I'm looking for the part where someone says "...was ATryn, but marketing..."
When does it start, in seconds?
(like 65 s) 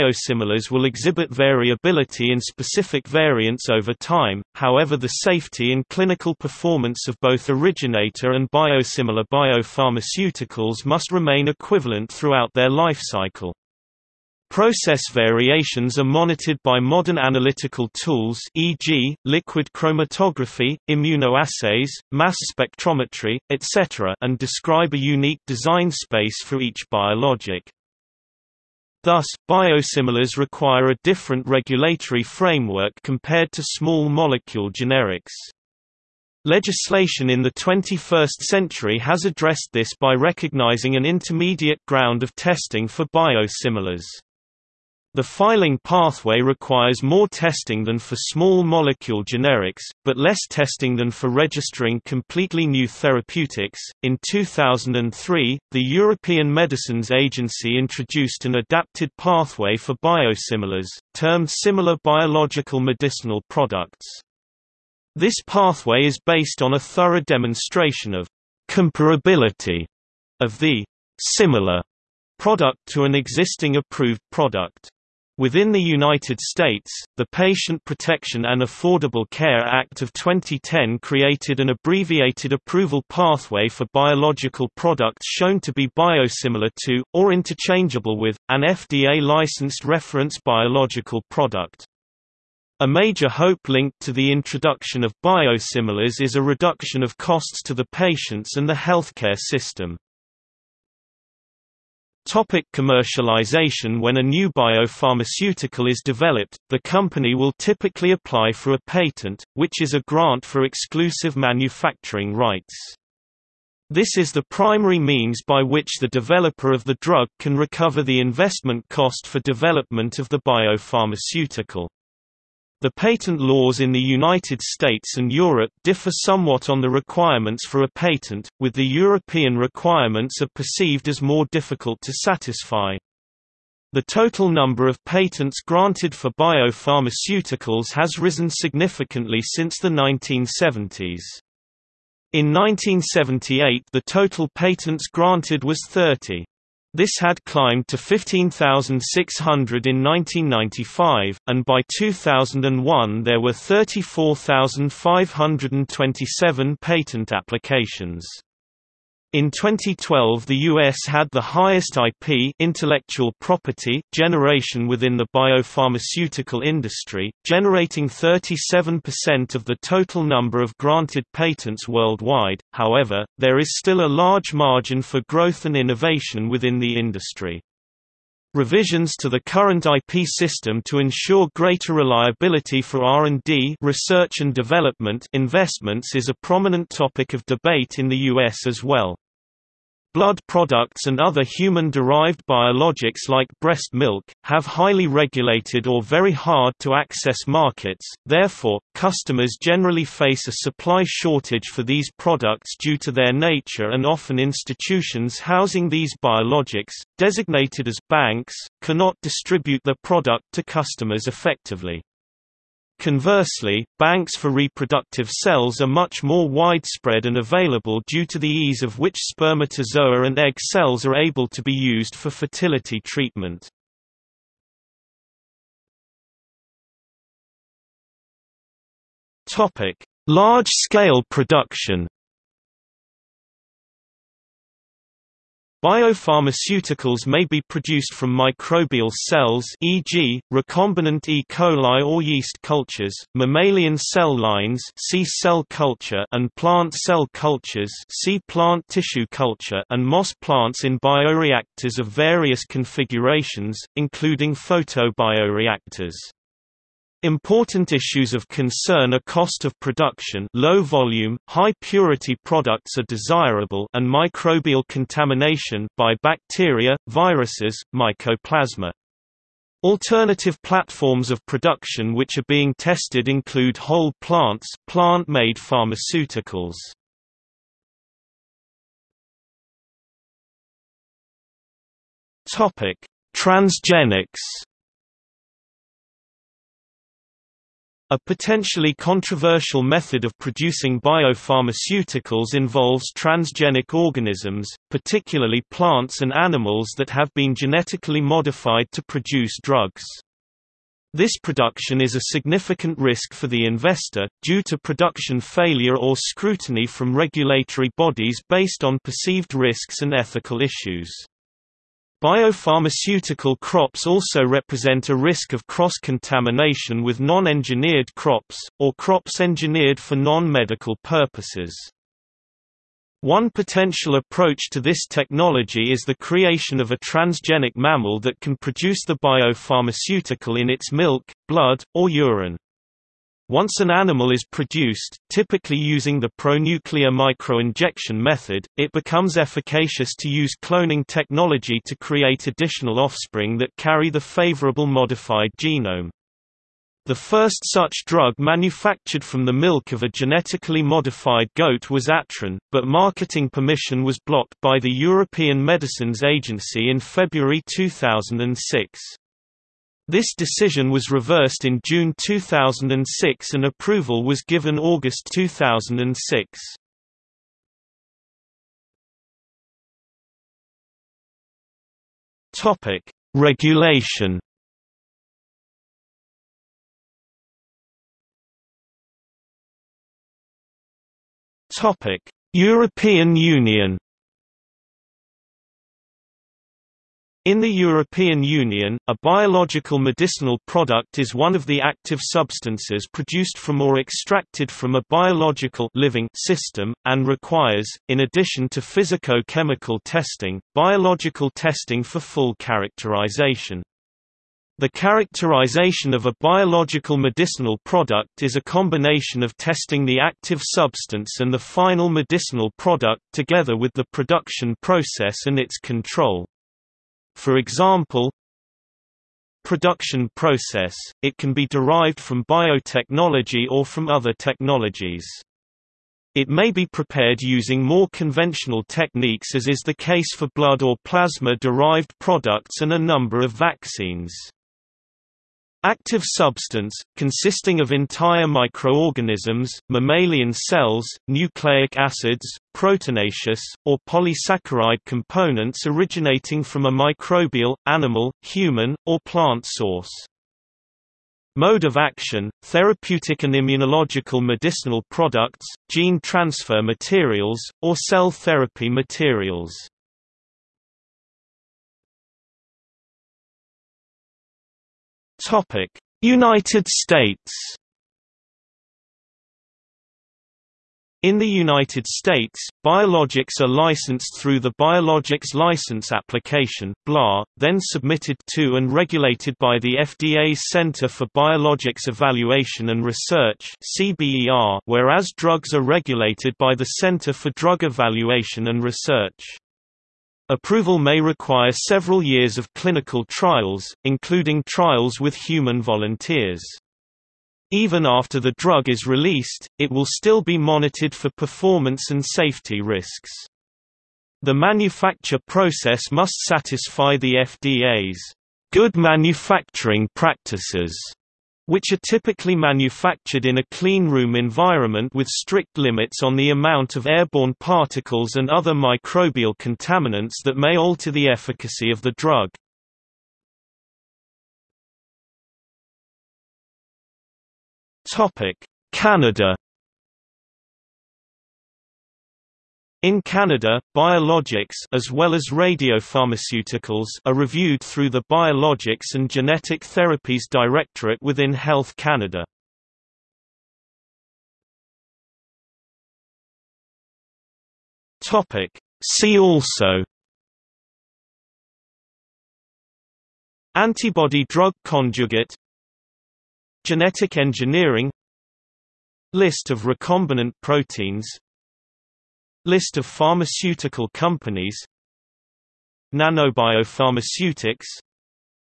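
351 s.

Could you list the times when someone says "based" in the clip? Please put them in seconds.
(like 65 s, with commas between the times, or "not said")
66 s, 308 s.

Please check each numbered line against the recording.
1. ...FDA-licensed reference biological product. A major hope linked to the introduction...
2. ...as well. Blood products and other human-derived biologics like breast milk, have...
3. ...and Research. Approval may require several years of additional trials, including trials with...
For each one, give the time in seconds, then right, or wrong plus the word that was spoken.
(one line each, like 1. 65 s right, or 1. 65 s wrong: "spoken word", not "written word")
1. 88 s right
2. 188 s right
3. 488 s wrong: "clinical", not "additional".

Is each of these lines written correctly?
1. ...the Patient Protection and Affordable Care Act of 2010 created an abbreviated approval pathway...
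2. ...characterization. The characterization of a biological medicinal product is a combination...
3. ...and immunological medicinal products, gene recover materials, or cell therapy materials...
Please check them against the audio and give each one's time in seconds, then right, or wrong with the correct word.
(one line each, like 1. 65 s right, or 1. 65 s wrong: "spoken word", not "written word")
1. 77 s right
2. 402 s right
3. 453 s wrong: "transfer", not "recover".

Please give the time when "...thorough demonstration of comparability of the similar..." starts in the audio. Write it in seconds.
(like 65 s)
66 s.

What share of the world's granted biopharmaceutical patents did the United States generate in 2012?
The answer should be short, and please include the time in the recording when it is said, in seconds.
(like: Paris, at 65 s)
37%, at 168 s.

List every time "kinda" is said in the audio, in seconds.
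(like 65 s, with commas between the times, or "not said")
not said.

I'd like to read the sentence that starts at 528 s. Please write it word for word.
Canada In Canada, biologics as well as radiopharmaceuticals are reviewed through the Biologics and Genetic Therapies Directorate within Health Canada.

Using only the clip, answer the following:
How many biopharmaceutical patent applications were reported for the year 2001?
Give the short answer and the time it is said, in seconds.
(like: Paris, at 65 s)
34,527, at 153 s.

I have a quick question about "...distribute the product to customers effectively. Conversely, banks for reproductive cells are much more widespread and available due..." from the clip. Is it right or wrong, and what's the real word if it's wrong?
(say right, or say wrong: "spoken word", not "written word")
right.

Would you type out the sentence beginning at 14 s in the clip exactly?
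Process variations are monitored by modern analytical tools e.g., liquid chromatography, immunoassays, mass spectrometry, etc.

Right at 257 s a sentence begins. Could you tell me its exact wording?
Important issues of concern are cost of production low volume, high purity products are desirable and microbial contamination by bacteria, viruses, mycoplasma.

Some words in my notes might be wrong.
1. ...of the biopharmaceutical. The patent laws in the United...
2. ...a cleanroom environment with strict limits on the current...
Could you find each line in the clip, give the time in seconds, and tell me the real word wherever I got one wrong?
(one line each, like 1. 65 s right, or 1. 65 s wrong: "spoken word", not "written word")
1. 120 s right
2. 513 s wrong: "amount", not "current".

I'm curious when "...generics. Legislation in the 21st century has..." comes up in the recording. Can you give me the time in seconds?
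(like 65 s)
34 s.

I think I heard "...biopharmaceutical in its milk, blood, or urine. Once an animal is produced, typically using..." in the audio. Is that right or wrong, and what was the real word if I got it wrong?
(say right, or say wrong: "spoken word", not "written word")
right.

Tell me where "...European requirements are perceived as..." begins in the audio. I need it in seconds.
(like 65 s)
128 s.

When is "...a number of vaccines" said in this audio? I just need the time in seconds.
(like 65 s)
432 s.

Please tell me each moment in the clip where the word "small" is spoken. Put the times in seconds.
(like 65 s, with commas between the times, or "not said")
33 s, 48 s.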